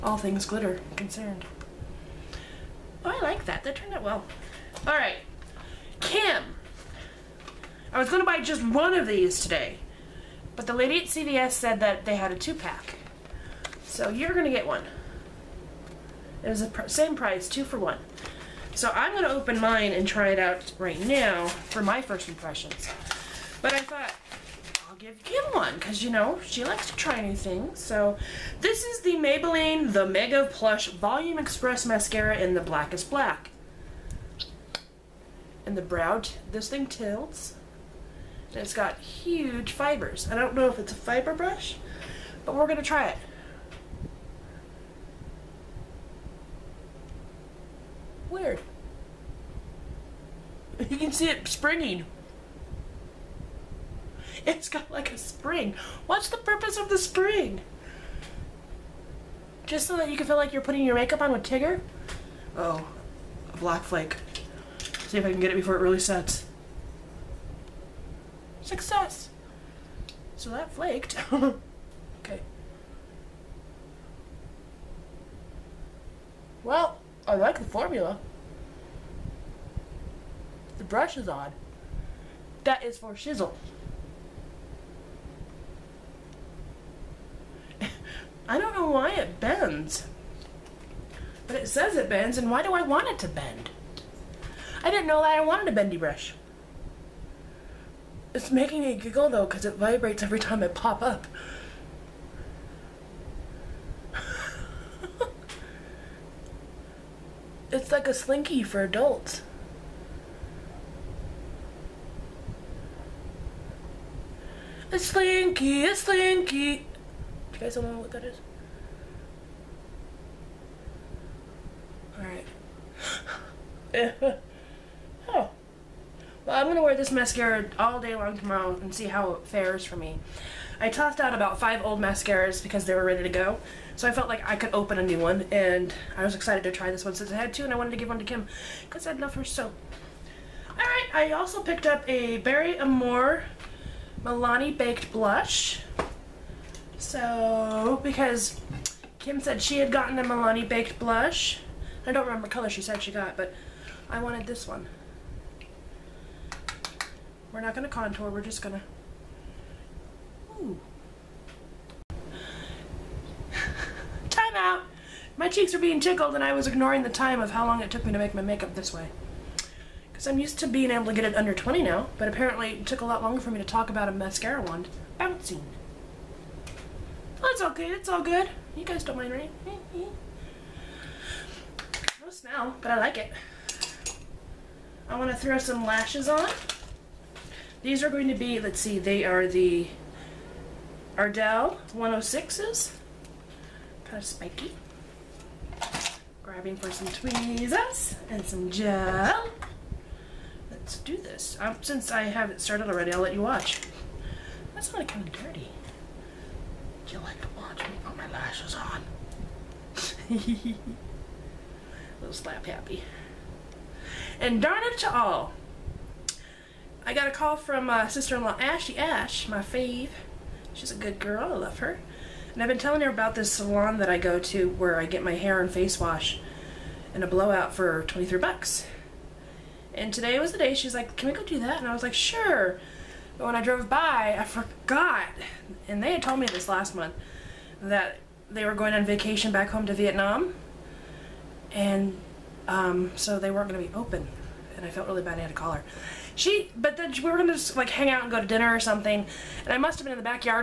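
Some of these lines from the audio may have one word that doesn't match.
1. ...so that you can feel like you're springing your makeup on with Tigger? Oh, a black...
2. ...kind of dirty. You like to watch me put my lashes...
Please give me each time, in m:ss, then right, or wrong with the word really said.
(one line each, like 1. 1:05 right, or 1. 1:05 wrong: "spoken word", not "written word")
1. 0:59 wrong: "putting", not "springing"
2. 3:25 right.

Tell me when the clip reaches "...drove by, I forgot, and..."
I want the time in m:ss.
3:53.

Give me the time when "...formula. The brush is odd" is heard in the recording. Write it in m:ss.
1:17.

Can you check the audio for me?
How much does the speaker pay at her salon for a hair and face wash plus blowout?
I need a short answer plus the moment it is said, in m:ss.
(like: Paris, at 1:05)
$23, at 3:48.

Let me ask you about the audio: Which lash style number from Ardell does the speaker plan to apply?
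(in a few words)
106.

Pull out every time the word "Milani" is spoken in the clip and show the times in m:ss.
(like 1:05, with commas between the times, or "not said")
2:24, 2:30.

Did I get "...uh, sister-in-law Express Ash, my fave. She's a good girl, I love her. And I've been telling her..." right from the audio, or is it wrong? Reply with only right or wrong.
wrong.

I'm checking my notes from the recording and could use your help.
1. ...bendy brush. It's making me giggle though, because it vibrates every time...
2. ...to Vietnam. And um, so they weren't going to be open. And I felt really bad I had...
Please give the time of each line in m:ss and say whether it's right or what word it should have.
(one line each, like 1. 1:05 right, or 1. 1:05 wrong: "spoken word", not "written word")
1. 1:35 right
2. 3:59 right.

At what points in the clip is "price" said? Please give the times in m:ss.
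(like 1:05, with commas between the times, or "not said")
0:17.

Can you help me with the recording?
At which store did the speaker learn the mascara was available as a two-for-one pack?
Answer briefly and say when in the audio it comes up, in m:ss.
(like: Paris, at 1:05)
CVS, at 0:11.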